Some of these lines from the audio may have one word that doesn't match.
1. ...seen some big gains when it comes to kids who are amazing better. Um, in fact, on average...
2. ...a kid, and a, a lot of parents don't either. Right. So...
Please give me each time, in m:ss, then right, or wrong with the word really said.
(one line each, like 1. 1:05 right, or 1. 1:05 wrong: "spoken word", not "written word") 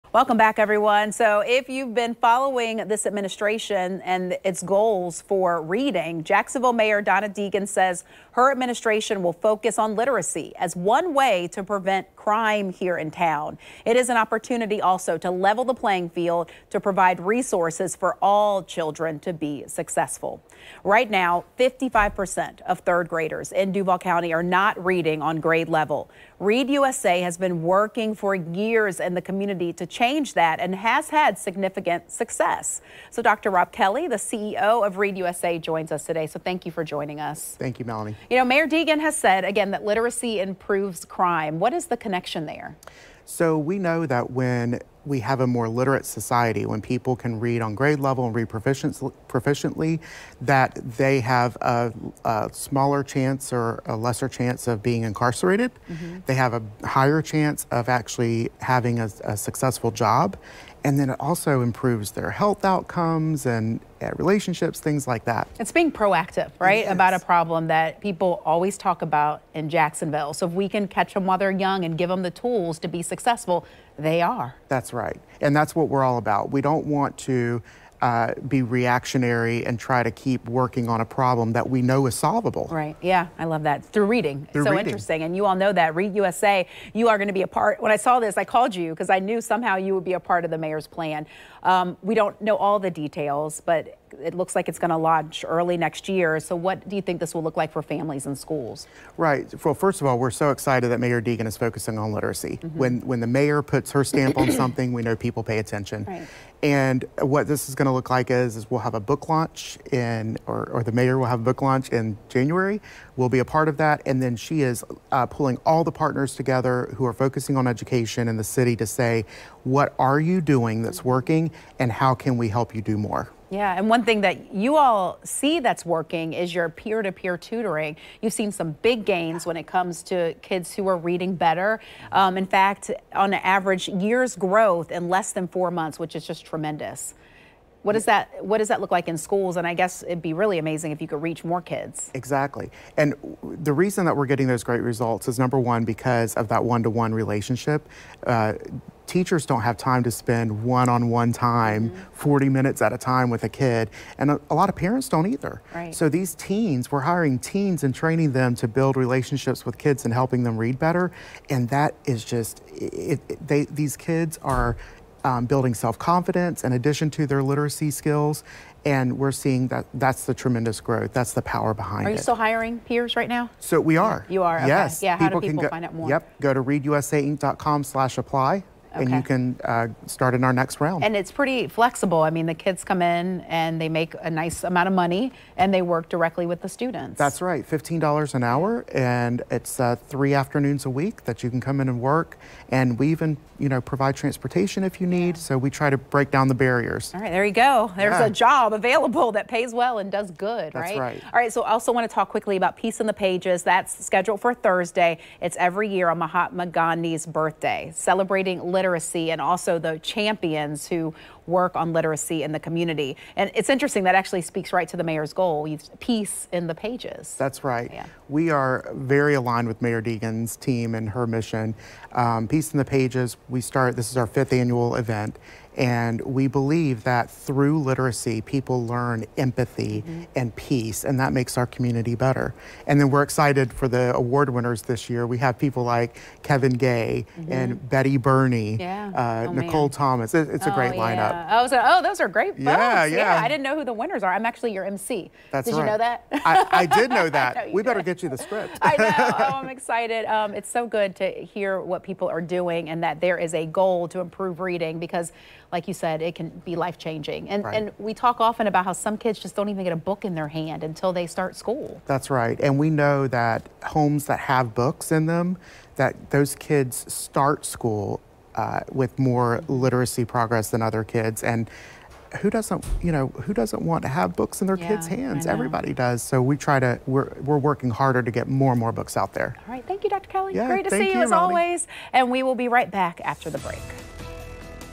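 1. 2:08 wrong: "reading", not "amazing"
2. 2:33 right.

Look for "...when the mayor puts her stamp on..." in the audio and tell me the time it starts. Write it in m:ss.
1:43.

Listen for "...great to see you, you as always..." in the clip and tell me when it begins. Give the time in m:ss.
4:40.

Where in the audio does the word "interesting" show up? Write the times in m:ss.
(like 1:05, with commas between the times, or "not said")
1:24, 3:33.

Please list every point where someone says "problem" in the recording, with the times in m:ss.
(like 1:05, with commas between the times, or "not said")
1:07, 1:21.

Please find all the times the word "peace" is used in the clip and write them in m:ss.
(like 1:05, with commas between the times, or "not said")
3:22, 3:35, 3:42, 3:50.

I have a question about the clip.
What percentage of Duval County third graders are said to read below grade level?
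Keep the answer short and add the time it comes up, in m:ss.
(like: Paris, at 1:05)
55%, at 0:21.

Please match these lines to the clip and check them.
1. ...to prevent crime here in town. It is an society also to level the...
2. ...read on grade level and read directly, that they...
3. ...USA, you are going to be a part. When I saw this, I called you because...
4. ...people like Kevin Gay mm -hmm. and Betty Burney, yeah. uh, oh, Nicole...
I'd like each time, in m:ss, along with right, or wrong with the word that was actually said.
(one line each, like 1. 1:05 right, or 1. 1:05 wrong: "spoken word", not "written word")
1. 0:11 wrong: "opportunity", not "society"
2. 0:47 wrong: "proficiently", not "directly"
3. 1:26 right
4. 3:55 right.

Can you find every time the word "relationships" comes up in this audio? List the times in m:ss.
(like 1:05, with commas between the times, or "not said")
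1:04, 2:27, 2:39.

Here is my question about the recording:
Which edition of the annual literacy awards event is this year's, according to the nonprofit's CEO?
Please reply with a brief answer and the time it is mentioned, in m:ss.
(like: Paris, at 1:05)
fifth, at 3:44.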